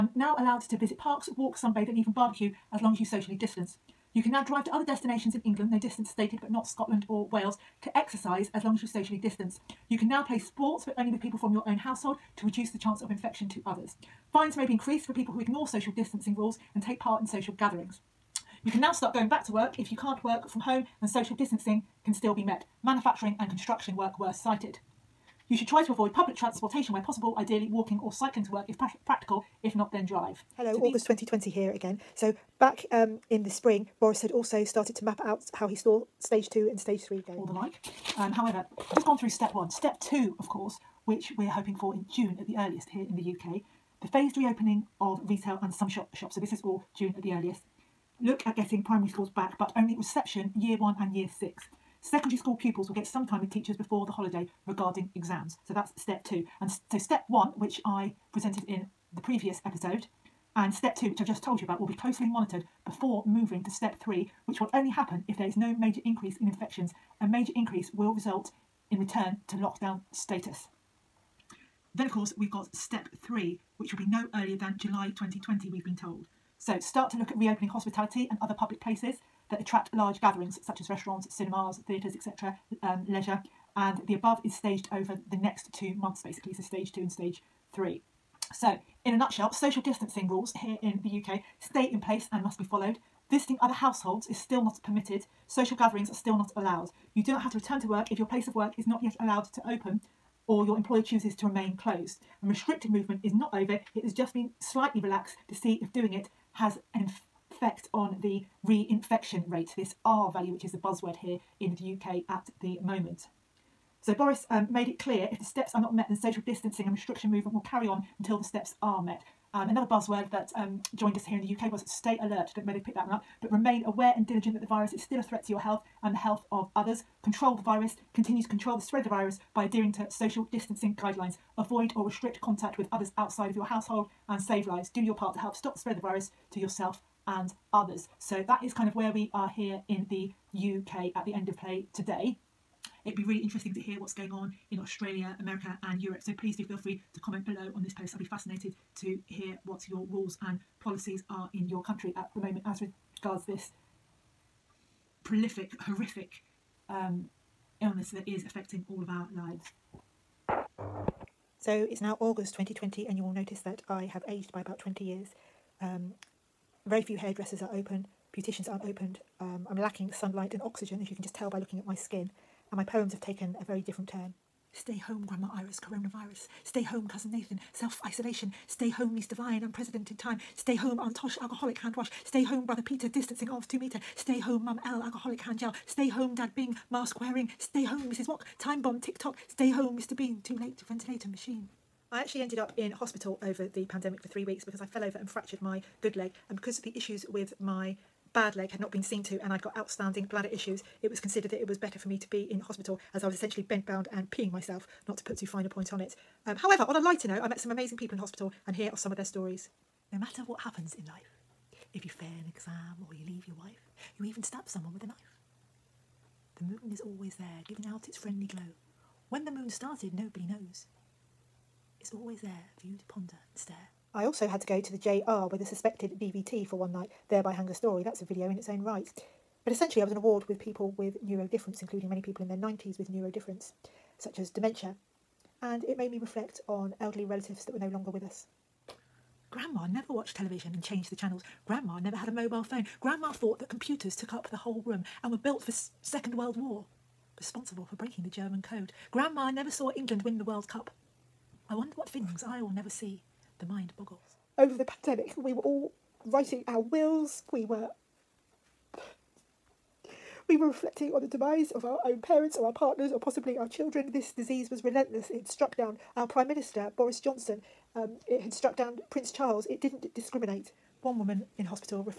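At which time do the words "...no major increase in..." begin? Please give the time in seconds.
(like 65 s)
65 s.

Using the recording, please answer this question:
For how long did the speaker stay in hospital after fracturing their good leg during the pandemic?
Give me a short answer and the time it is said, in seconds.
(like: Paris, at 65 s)
3 weeks, at 194 s.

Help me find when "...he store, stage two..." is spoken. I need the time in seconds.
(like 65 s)
35 s.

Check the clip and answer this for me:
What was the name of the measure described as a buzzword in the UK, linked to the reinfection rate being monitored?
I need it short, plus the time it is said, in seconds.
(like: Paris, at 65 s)
R value, at 110 s.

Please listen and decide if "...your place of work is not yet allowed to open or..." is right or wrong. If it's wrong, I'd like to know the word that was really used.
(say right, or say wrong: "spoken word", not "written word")
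right.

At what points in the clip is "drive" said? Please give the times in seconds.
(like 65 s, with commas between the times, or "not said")
4 s, 30 s.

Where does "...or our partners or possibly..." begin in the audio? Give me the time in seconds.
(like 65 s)
262 s.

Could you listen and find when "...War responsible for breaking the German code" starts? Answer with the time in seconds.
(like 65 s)
246 s.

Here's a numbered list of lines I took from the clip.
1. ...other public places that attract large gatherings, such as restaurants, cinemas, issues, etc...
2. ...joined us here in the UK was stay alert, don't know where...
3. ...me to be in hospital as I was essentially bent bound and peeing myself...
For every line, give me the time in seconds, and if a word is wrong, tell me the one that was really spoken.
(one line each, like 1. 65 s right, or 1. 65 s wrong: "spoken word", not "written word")
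1. 78 s wrong: "theatres", not "issues"
2. 120 s right
3. 202 s right.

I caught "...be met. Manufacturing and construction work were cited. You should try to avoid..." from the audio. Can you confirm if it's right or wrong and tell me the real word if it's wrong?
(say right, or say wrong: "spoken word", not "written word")
right.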